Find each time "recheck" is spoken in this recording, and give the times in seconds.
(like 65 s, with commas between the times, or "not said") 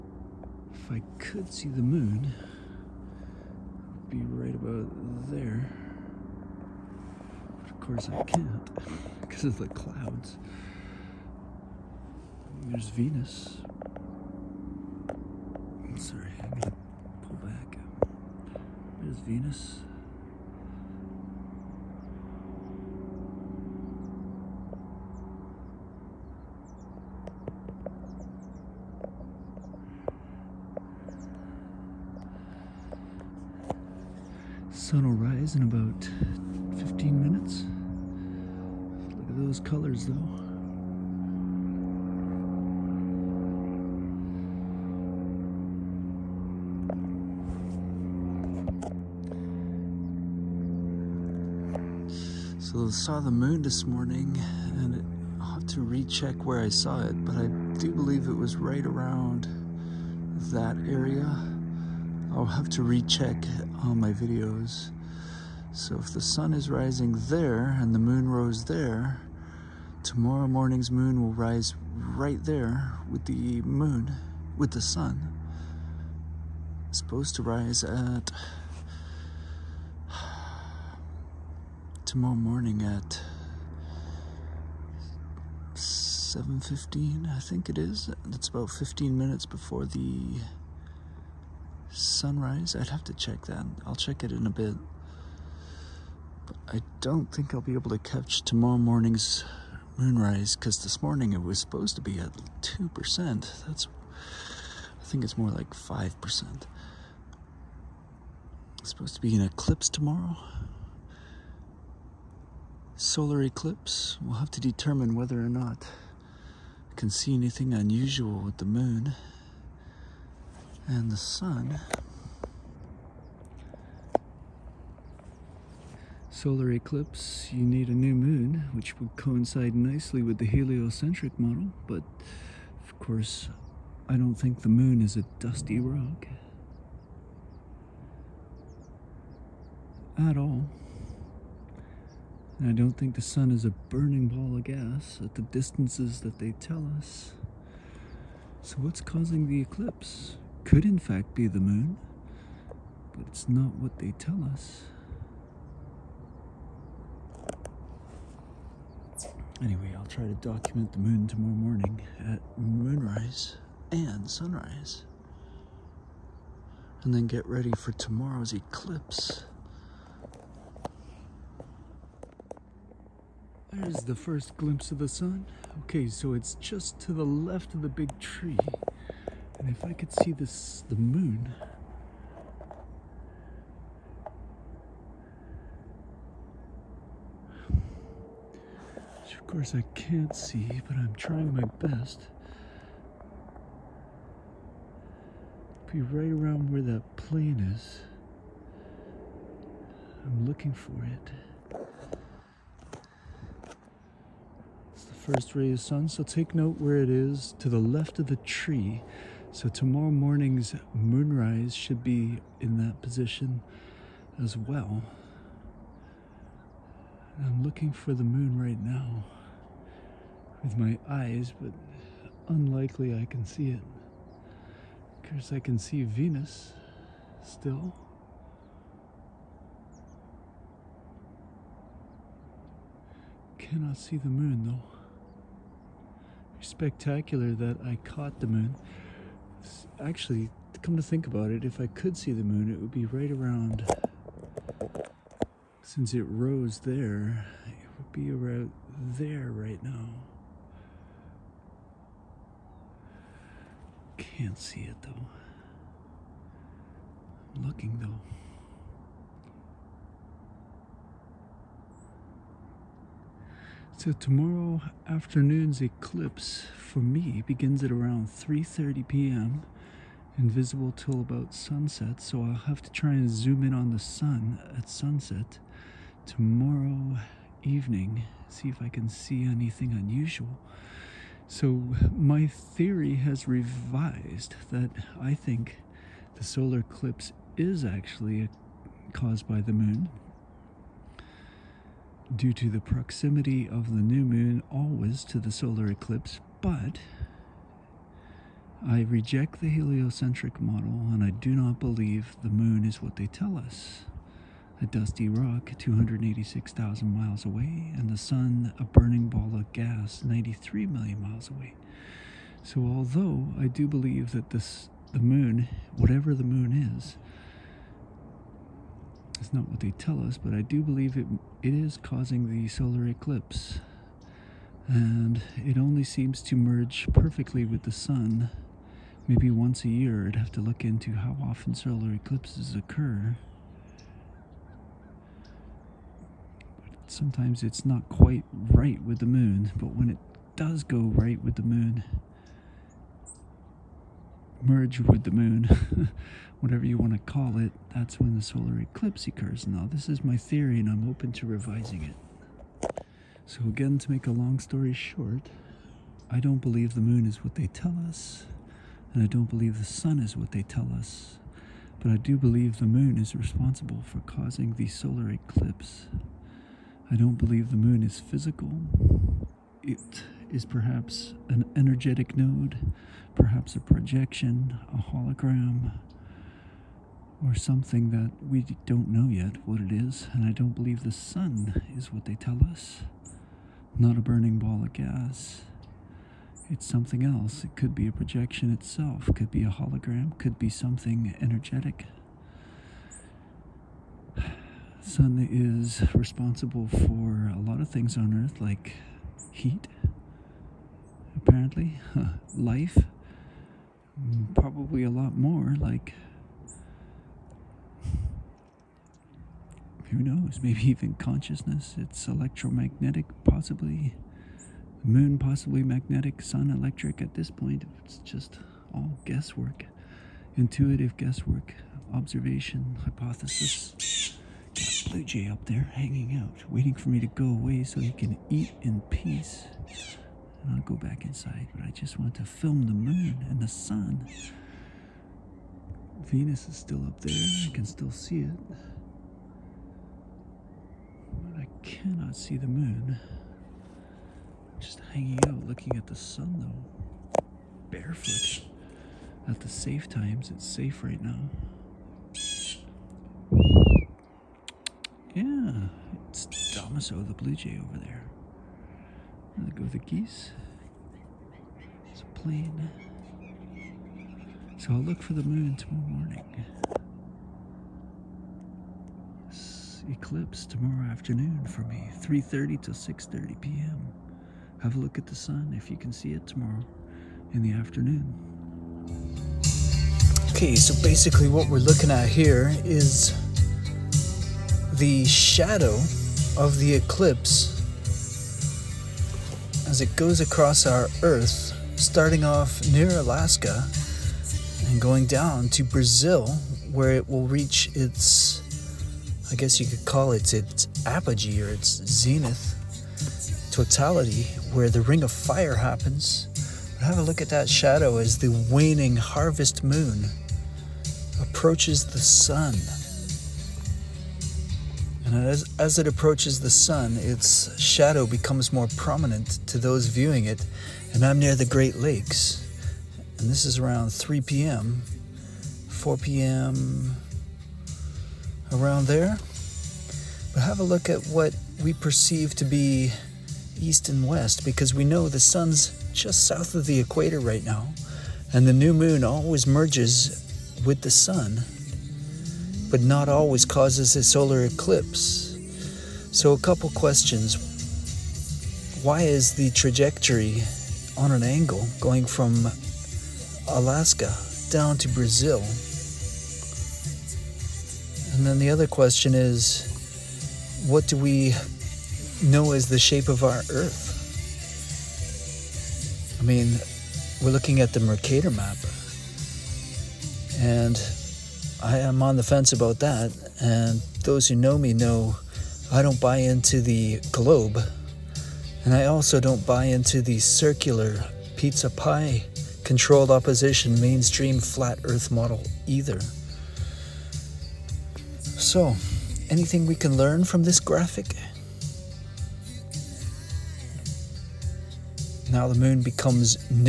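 55 s, 62 s.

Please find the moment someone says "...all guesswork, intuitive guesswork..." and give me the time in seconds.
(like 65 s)
418 s.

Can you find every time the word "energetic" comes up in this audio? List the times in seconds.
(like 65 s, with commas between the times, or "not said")
371 s, 391 s.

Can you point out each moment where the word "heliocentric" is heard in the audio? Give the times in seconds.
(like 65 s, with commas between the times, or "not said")
130 s, 299 s.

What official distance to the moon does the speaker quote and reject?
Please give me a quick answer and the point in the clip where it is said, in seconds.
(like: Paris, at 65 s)
286,000 miles, at 305 s.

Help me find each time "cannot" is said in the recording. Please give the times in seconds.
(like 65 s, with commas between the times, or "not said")
233 s, 441 s.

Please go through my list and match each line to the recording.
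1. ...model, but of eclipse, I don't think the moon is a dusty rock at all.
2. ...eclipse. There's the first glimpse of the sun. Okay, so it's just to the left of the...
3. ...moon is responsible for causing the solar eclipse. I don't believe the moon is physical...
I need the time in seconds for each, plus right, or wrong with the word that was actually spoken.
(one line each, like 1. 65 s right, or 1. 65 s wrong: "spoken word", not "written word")
1. 131 s wrong: "course", not "eclipse"
2. 168 s right
3. 362 s right.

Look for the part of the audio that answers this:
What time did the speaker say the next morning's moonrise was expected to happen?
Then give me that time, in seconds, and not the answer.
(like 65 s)
85 s.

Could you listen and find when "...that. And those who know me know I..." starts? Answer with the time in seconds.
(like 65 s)
573 s.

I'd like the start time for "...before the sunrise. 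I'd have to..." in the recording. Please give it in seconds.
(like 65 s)
89 s.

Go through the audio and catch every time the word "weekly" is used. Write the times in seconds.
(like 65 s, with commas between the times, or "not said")
not said.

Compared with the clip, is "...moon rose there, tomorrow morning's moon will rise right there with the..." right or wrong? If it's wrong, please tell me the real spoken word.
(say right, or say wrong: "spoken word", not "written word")
right.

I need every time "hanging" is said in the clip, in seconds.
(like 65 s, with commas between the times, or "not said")
425 s, 445 s.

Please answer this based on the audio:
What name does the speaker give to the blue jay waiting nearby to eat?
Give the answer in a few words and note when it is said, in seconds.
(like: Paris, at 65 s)
Damaso, at 456 s.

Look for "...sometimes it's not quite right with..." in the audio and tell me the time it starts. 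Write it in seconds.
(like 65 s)
337 s.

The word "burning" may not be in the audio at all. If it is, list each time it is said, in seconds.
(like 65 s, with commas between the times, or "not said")
143 s, 308 s, 384 s.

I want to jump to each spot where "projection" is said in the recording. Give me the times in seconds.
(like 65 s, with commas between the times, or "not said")
373 s, 388 s.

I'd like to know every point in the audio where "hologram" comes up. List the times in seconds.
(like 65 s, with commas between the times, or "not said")
375 s, 389 s.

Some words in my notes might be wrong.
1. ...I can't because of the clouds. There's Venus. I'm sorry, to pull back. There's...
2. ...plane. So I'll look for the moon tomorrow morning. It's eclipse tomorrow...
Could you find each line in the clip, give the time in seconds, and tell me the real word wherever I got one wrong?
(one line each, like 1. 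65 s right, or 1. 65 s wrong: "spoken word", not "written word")
1. 8 s right
2. 462 s right.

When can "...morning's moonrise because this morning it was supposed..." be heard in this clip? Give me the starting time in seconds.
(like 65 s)
98 s.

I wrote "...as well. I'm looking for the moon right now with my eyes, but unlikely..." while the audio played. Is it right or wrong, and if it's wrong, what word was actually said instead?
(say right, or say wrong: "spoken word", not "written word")
right.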